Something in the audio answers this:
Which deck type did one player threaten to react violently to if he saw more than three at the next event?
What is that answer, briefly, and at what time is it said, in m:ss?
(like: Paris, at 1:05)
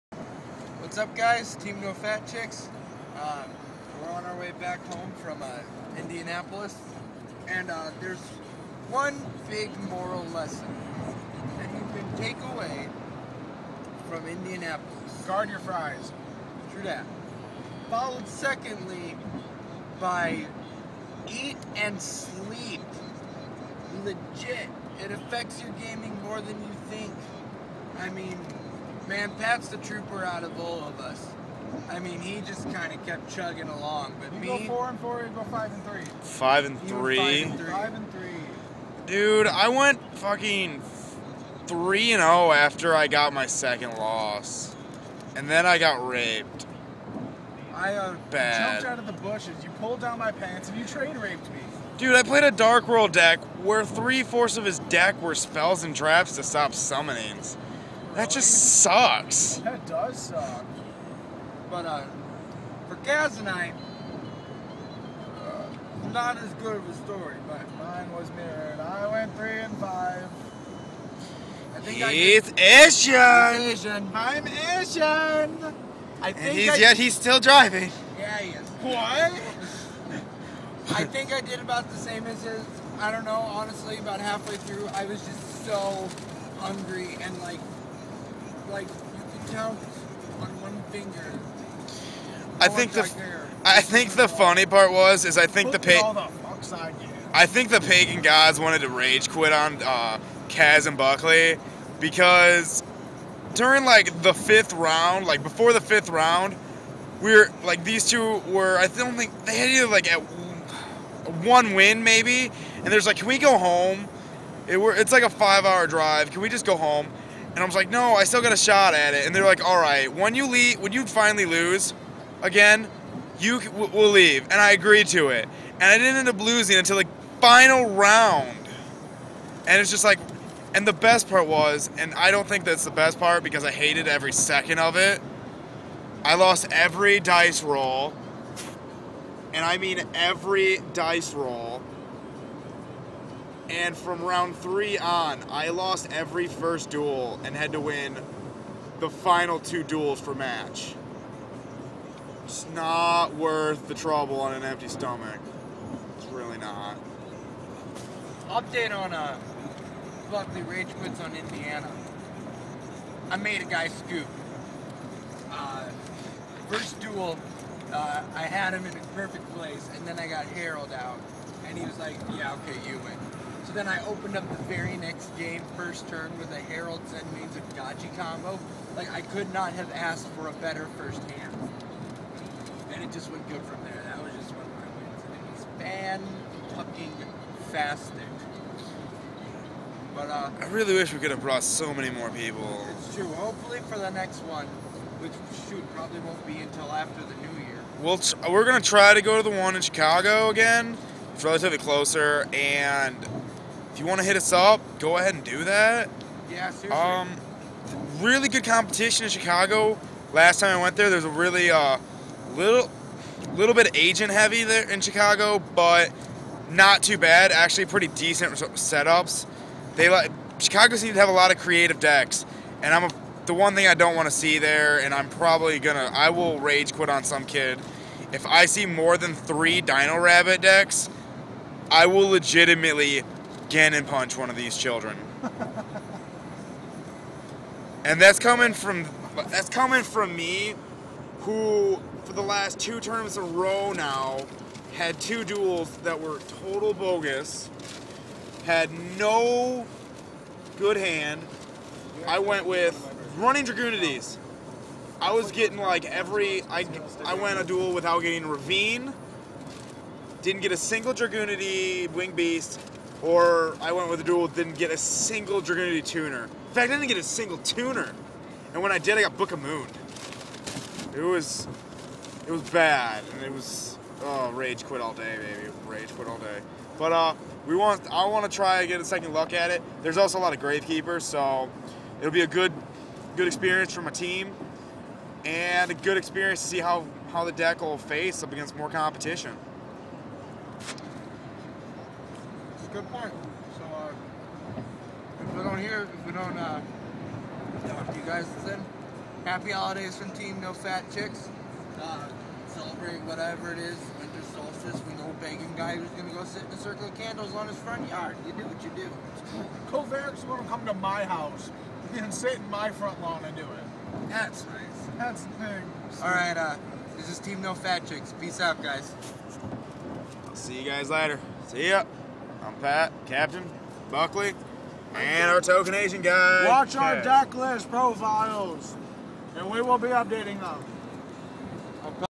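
Dino Rabbit, at 3:49.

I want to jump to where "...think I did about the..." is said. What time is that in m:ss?
1:21.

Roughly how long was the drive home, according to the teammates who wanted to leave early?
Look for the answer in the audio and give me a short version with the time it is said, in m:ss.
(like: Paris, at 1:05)
5 hours, at 1:55.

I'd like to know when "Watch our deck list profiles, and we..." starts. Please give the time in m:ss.
5:26.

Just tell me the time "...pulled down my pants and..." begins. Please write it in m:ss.
0:49.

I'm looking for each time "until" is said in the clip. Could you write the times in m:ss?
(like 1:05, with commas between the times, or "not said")
2:06, 3:16.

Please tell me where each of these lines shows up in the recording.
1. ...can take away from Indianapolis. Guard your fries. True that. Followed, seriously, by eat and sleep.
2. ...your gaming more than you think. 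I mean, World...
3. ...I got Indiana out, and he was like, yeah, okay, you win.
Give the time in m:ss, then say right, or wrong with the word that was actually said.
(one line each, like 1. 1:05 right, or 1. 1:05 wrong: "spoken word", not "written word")
1. 0:11 wrong: "secondly", not "seriously"
2. 0:25 wrong: "Man", not "World"
3. 2:50 wrong: "Herald", not "Indiana".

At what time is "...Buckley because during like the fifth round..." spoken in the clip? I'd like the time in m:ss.
1:40.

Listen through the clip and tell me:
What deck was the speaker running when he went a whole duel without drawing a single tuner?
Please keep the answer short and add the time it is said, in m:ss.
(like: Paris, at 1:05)
Dragunities, at 4:13.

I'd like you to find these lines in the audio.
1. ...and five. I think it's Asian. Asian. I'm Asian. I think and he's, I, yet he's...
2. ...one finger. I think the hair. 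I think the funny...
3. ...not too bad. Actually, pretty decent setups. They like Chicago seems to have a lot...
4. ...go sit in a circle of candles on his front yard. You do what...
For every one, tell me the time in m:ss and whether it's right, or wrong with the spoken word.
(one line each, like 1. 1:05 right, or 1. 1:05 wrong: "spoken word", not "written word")
1. 1:09 right
2. 1:30 right
3. 3:36 right
4. 5:06 right.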